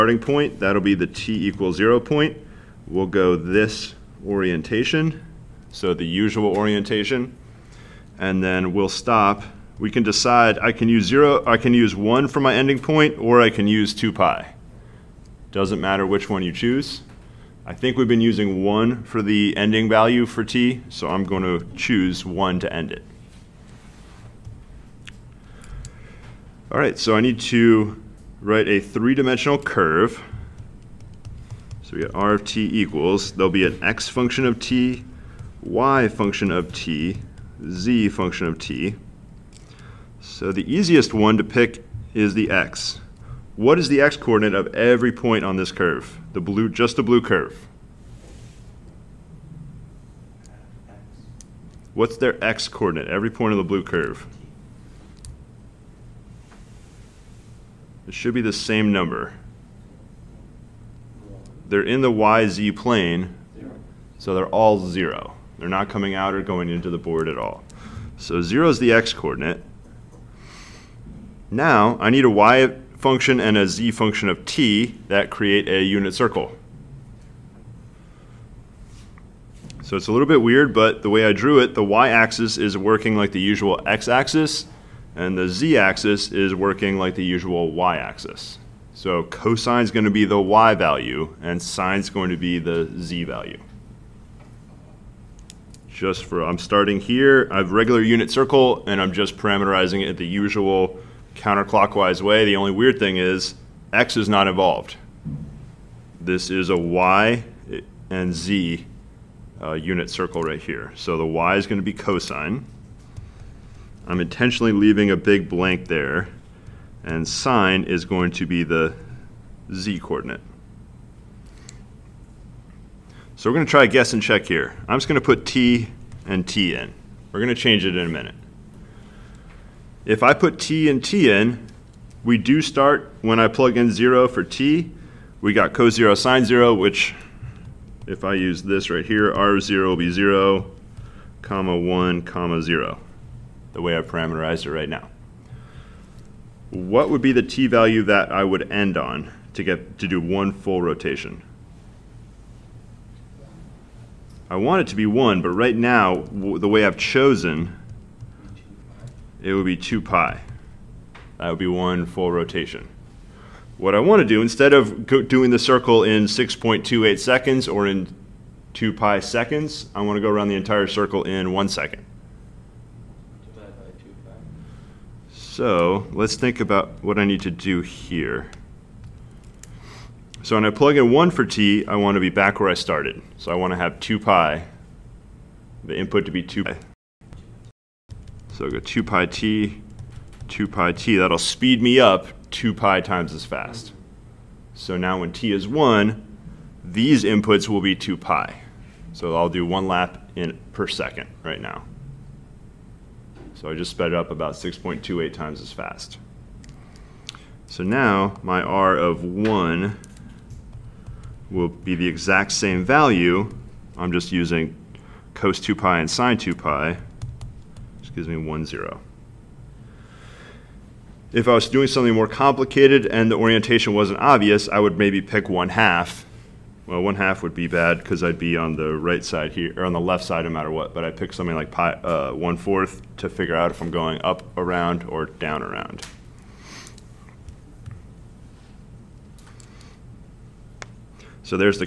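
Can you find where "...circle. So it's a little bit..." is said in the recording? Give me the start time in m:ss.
1:16.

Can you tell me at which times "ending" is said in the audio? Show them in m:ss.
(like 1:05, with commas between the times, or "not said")
0:12, 0:19.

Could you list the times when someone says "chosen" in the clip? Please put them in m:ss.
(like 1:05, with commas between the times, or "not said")
2:36.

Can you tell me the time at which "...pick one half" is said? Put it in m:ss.
3:45.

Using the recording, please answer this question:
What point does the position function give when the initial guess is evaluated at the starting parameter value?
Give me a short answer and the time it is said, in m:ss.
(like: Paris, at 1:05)
(0, 1, 0), at 2:20.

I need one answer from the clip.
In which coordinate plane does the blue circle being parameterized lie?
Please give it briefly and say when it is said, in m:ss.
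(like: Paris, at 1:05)
YZ plane, at 1:02.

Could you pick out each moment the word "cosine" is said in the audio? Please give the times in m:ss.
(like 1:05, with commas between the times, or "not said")
1:29, 1:51.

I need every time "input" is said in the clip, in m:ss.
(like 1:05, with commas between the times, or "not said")
3:05, 3:17.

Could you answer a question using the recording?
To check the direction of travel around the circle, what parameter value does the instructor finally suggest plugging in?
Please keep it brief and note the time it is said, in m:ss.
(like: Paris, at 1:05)
1/4, at 3:52.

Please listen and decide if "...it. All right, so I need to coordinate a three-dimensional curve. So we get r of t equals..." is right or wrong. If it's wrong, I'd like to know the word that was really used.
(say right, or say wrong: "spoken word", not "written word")
wrong: "write", not "coordinate".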